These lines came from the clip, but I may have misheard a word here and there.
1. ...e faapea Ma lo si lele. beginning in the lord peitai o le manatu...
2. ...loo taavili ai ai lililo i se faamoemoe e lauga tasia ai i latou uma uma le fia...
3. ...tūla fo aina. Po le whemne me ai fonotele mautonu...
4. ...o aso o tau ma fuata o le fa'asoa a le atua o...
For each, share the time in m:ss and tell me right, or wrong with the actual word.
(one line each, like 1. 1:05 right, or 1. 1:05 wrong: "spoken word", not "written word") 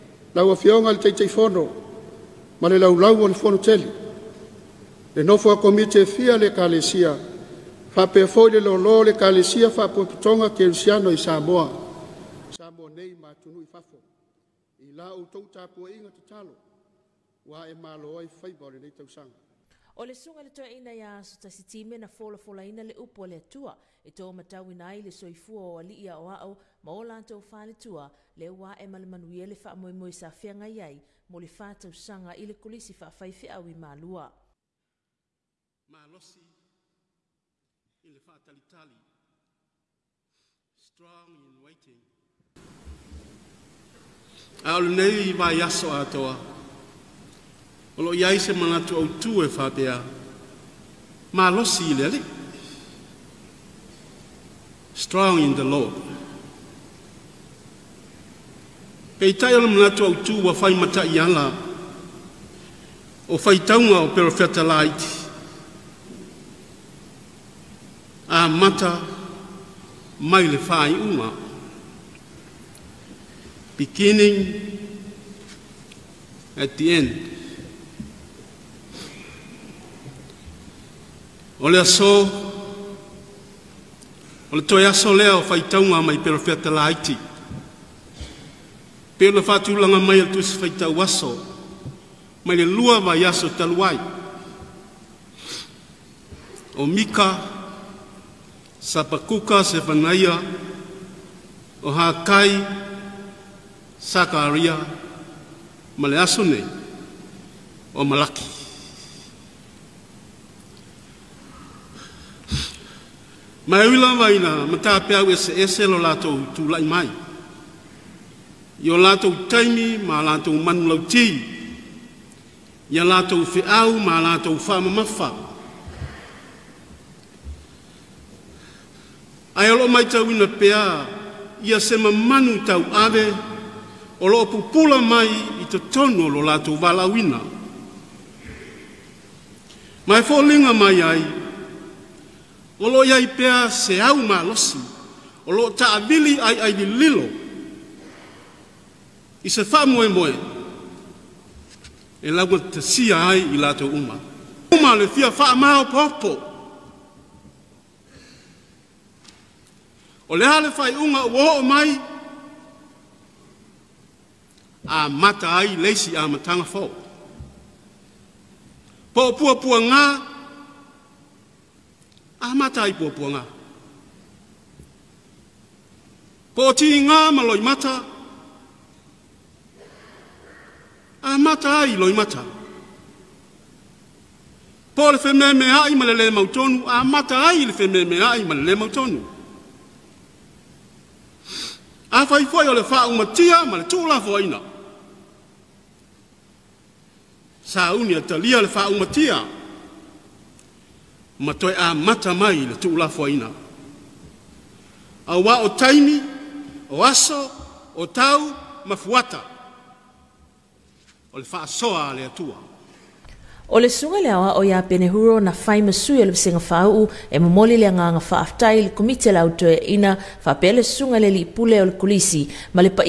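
1. 0:49 wrong: "strong", not "beginning"
2. 2:25 right
3. 3:13 wrong: "malele", not "fonotele"
4. 3:26 right.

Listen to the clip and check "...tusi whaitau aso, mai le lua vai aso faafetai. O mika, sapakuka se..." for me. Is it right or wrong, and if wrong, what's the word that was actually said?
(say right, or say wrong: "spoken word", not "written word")
wrong: "taluai", not "faafetai".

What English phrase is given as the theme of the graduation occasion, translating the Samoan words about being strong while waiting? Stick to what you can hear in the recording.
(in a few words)
Strong in waiting.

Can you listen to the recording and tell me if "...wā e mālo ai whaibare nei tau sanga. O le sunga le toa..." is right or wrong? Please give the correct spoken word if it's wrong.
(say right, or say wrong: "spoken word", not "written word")
right.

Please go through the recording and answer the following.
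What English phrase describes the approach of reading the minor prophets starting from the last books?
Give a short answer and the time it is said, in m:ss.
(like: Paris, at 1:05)
Beginning at the end, at 1:13.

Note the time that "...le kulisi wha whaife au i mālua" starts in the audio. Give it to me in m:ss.
0:32.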